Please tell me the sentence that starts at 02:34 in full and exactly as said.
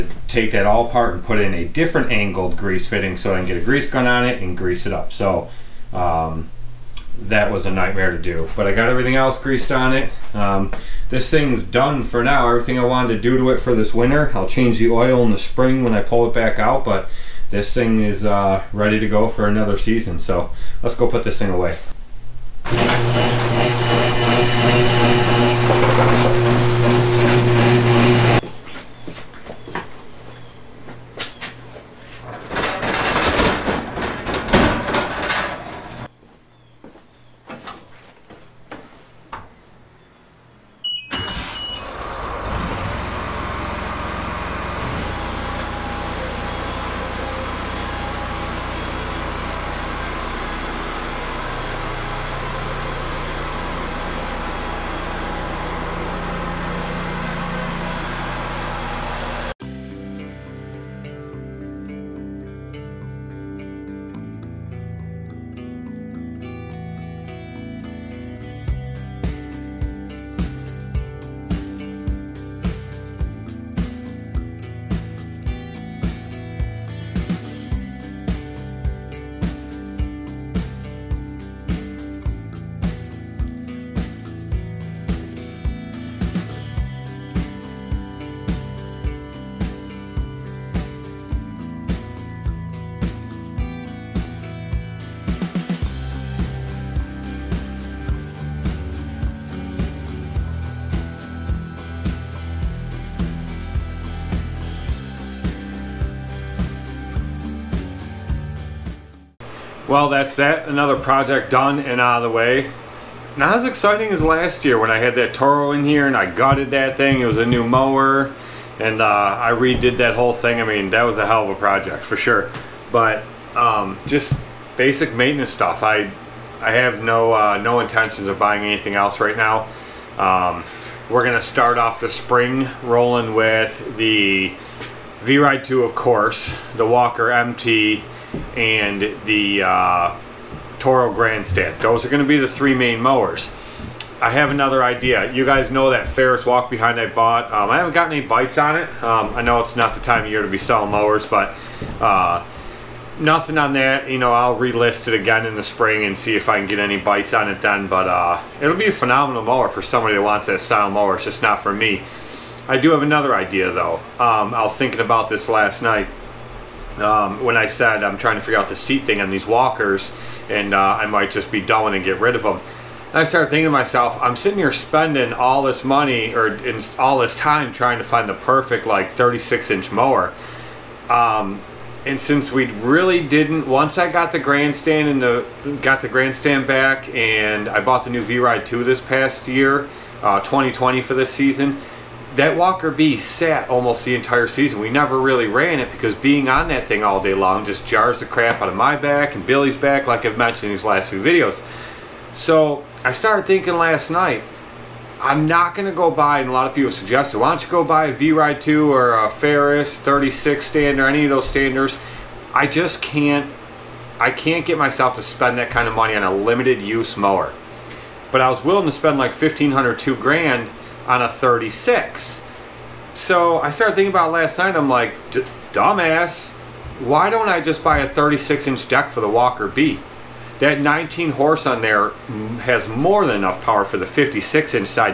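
You know, I'll relist it again in the spring and see if I can get any bites on it then.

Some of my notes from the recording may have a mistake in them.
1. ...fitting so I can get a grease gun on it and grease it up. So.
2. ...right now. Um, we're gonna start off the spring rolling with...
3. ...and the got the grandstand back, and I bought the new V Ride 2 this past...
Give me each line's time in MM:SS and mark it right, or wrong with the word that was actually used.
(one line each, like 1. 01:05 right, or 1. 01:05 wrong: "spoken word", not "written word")
1. 00:02 right
2. 02:09 right
3. 03:05 right.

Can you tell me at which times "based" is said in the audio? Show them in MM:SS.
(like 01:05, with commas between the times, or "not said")
not said.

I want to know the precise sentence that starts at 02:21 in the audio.
Those are going to be the three main mowers.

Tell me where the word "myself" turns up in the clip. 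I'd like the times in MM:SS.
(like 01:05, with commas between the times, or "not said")
02:53, 03:34.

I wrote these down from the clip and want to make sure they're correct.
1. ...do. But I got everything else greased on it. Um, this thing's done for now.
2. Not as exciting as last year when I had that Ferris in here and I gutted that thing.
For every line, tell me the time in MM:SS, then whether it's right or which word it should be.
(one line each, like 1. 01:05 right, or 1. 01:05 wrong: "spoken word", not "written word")
1. 00:08 right
2. 01:53 wrong: "Toro", not "Ferris".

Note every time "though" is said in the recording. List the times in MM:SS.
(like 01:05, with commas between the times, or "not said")
02:43.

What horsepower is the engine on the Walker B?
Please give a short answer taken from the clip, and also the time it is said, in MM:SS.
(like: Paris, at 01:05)
19, at 03:50.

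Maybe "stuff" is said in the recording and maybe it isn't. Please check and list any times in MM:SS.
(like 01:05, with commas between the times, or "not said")
02:05.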